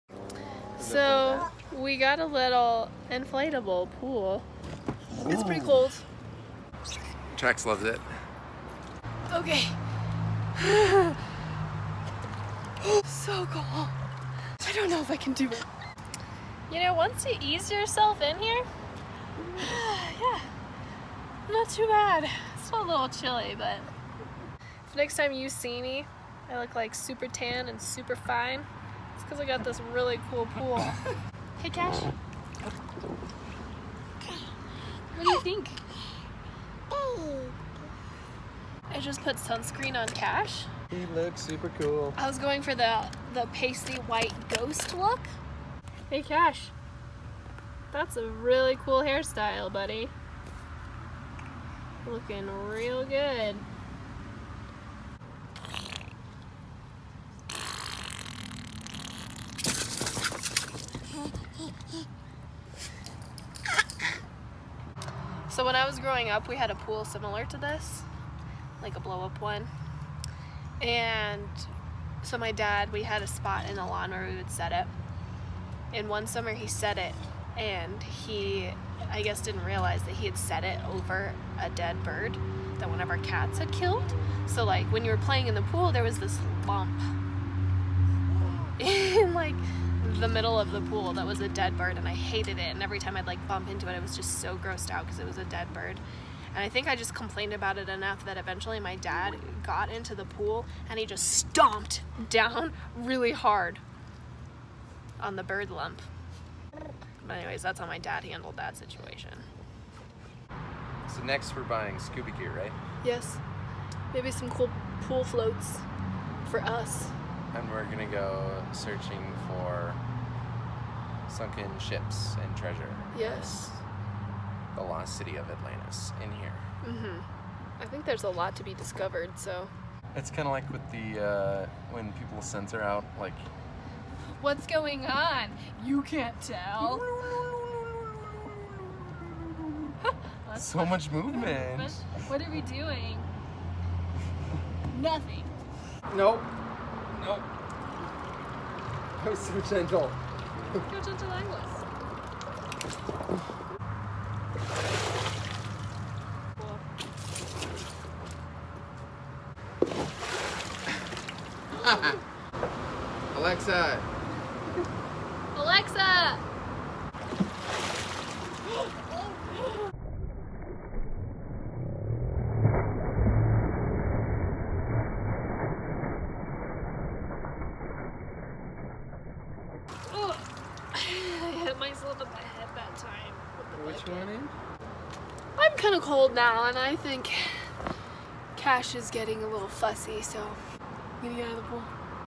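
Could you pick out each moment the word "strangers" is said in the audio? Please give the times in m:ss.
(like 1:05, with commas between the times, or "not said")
not said.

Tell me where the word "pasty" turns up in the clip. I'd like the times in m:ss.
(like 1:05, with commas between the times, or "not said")
0:43.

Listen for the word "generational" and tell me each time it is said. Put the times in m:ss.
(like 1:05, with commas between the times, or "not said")
not said.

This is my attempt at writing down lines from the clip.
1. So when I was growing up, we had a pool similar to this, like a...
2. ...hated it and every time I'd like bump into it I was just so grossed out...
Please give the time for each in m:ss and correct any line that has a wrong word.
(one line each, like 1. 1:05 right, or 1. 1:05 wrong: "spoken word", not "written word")
1. 1:05 right
2. 1:32 right.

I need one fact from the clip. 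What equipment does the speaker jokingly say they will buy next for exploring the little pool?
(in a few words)
Scuba gear.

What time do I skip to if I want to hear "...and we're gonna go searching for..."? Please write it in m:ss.
1:57.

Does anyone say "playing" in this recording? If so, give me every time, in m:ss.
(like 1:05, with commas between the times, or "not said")
1:25.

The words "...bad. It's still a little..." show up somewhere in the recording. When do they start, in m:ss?
0:21.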